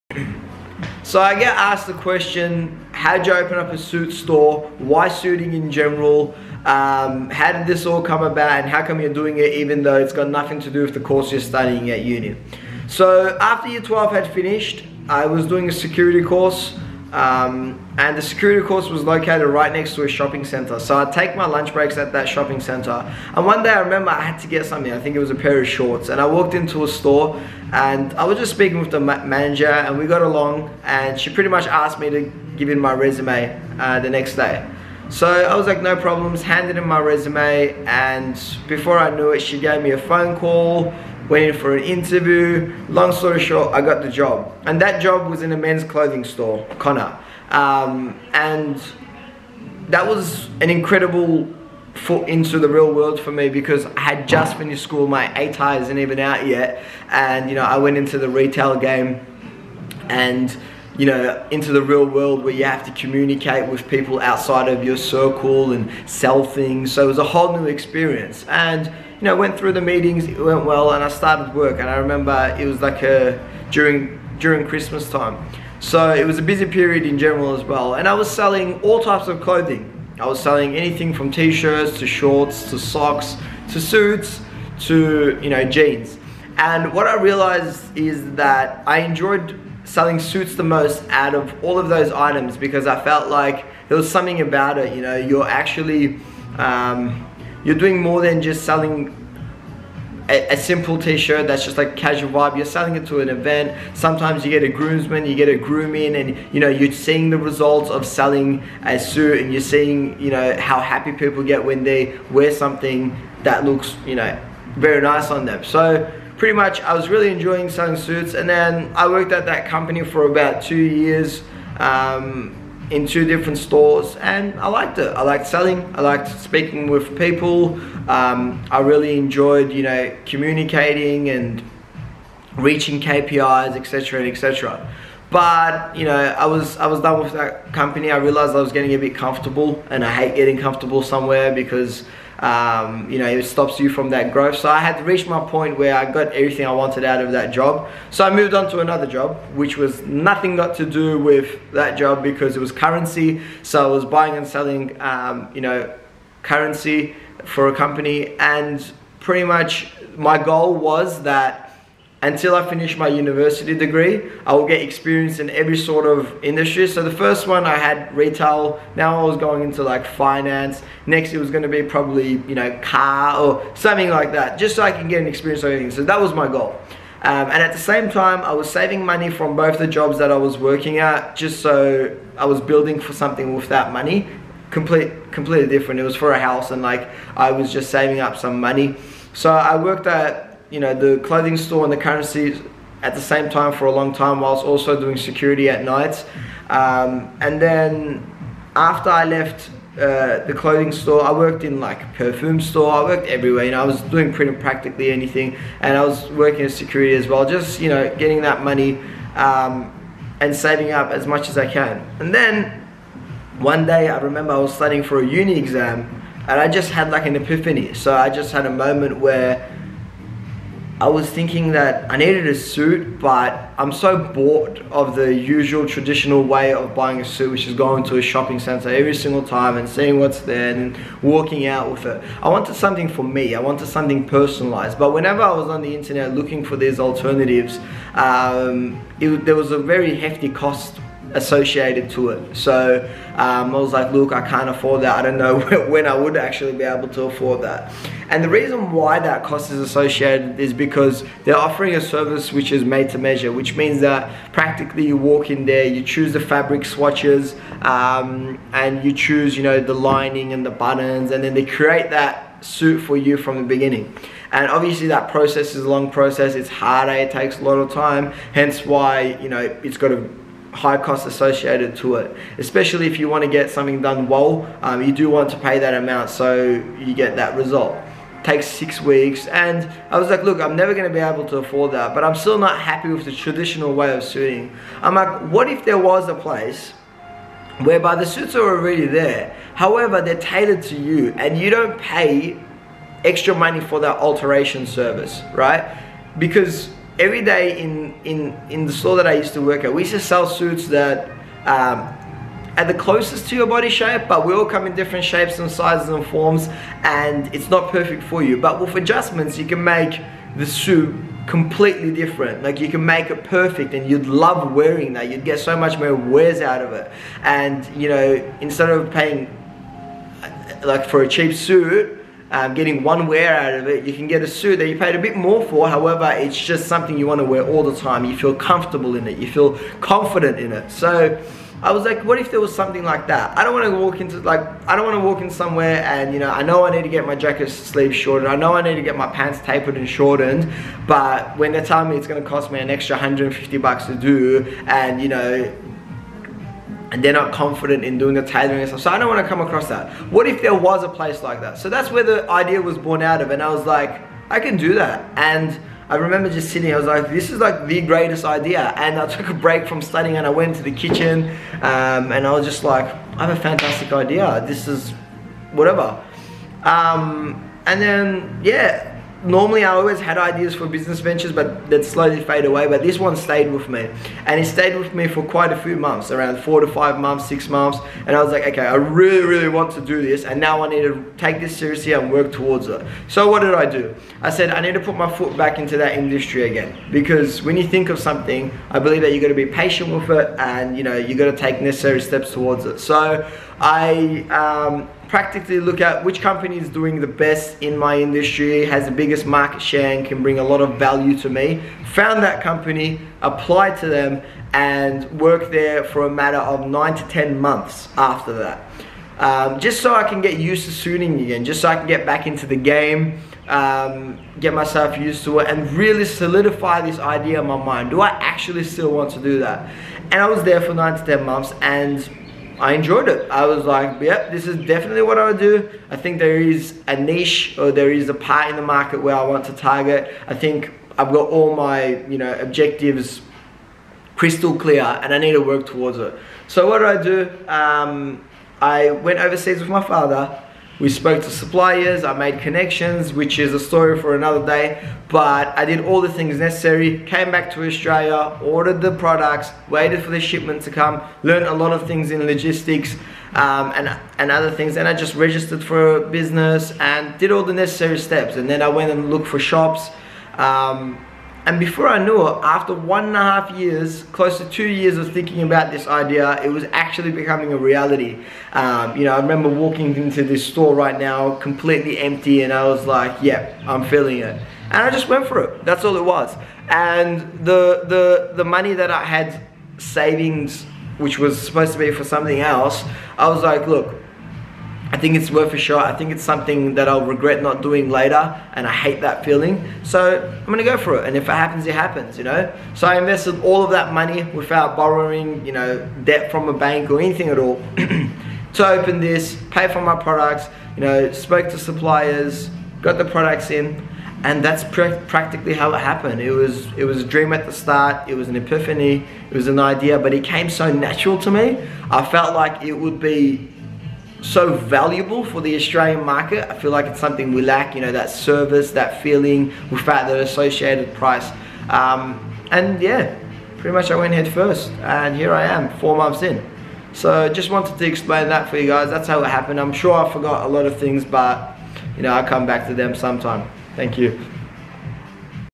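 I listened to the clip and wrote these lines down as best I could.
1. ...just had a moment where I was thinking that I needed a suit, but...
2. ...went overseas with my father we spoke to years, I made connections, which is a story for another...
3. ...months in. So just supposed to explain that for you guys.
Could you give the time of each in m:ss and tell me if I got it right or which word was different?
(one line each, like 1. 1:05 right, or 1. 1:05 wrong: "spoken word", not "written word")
1. 3:38 right
2. 7:19 wrong: "suppliers", not "years"
3. 8:46 wrong: "wanted", not "supposed".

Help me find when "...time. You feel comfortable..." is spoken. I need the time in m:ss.
5:27.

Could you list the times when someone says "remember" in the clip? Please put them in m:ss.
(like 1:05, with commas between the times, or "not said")
0:23, 1:11, 3:34, 5:56, 7:49.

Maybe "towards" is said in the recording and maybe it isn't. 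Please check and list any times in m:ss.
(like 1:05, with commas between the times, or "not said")
6:22, 6:32, 7:15.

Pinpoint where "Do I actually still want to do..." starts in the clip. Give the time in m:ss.
6:58.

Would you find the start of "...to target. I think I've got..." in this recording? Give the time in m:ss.
7:09.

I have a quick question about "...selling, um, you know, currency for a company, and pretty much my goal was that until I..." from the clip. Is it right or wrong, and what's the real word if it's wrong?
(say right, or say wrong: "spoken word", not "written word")
right.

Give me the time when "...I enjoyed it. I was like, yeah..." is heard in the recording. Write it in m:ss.
7:02.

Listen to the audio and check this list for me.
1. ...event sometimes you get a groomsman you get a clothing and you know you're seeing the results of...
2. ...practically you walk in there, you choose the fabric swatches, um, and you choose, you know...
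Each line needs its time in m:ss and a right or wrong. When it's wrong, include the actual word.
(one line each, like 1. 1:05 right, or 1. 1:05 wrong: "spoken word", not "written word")
1. 1:43 wrong: "grooming", not "clothing"
2. 4:14 right.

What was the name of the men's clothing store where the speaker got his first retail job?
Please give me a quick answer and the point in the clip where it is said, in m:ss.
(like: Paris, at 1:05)
Connor, at 0:46.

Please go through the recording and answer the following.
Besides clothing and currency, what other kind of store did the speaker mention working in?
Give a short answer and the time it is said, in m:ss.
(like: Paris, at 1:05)
Perfume store, at 3:22.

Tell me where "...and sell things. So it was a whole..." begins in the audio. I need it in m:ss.
1:05.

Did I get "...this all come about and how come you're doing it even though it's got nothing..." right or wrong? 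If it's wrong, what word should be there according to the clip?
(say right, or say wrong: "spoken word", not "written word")
right.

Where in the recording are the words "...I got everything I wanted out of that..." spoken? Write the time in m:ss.
2:25.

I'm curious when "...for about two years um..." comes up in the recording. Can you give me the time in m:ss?
2:00.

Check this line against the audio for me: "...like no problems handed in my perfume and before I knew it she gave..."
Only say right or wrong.
wrong.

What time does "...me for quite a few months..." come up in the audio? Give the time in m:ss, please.
6:15.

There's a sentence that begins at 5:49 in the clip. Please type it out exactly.
So I don't want to come across that.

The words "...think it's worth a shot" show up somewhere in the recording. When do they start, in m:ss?
8:05.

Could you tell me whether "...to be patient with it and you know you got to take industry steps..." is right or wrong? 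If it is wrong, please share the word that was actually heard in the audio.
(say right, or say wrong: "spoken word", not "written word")
wrong: "necessary", not "industry".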